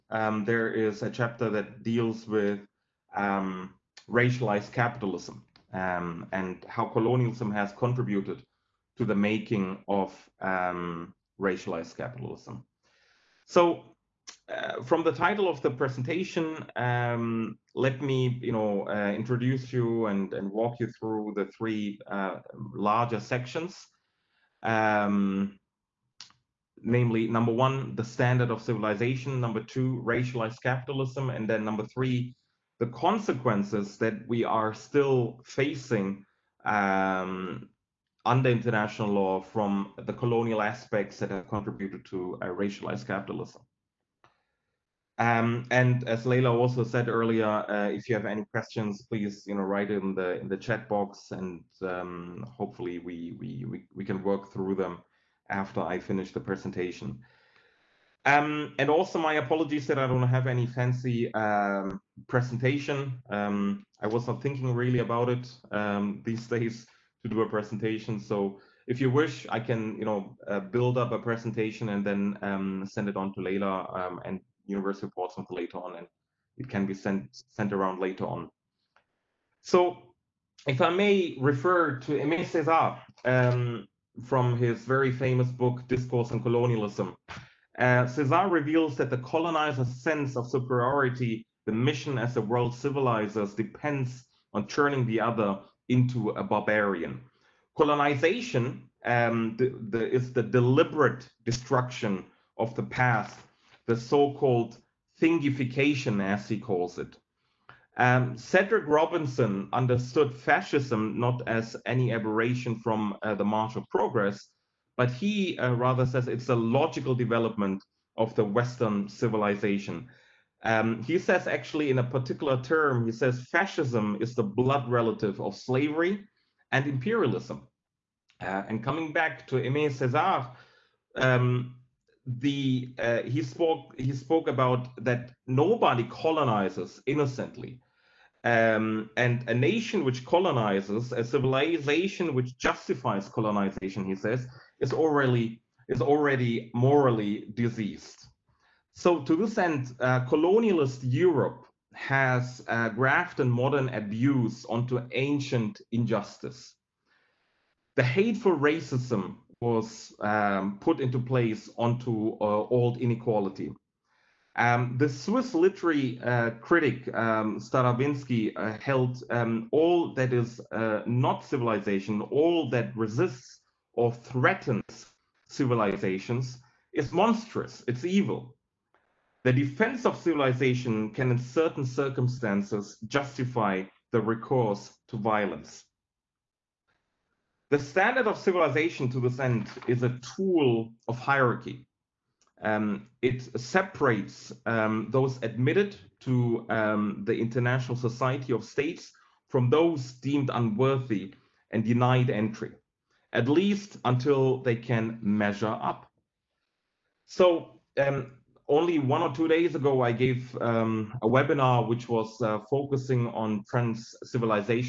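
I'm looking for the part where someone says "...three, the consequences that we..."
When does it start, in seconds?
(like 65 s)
31 s.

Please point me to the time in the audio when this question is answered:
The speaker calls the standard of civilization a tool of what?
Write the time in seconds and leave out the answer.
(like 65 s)
191 s.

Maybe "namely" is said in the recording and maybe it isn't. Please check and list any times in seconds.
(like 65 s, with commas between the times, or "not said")
26 s.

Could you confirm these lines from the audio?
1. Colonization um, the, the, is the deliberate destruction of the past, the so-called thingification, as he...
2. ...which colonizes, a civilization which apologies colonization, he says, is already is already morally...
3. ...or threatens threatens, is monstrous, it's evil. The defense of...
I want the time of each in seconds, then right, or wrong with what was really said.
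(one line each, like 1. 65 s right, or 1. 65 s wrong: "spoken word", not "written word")
1. 97 s right
2. 140 s wrong: "justifies", not "apologies"
3. 173 s wrong: "civilizations", not "threatens".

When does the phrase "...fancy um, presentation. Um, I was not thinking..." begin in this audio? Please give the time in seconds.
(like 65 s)
60 s.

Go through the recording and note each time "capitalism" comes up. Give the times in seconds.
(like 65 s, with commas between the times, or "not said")
4 s, 11 s, 30 s, 43 s.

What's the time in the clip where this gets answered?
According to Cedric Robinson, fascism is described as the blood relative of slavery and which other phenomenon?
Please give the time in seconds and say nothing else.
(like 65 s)
126 s.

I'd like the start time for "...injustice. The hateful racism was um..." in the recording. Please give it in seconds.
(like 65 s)
155 s.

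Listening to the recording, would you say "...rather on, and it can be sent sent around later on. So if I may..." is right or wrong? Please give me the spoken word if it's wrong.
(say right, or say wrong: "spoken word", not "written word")
wrong: "later", not "rather".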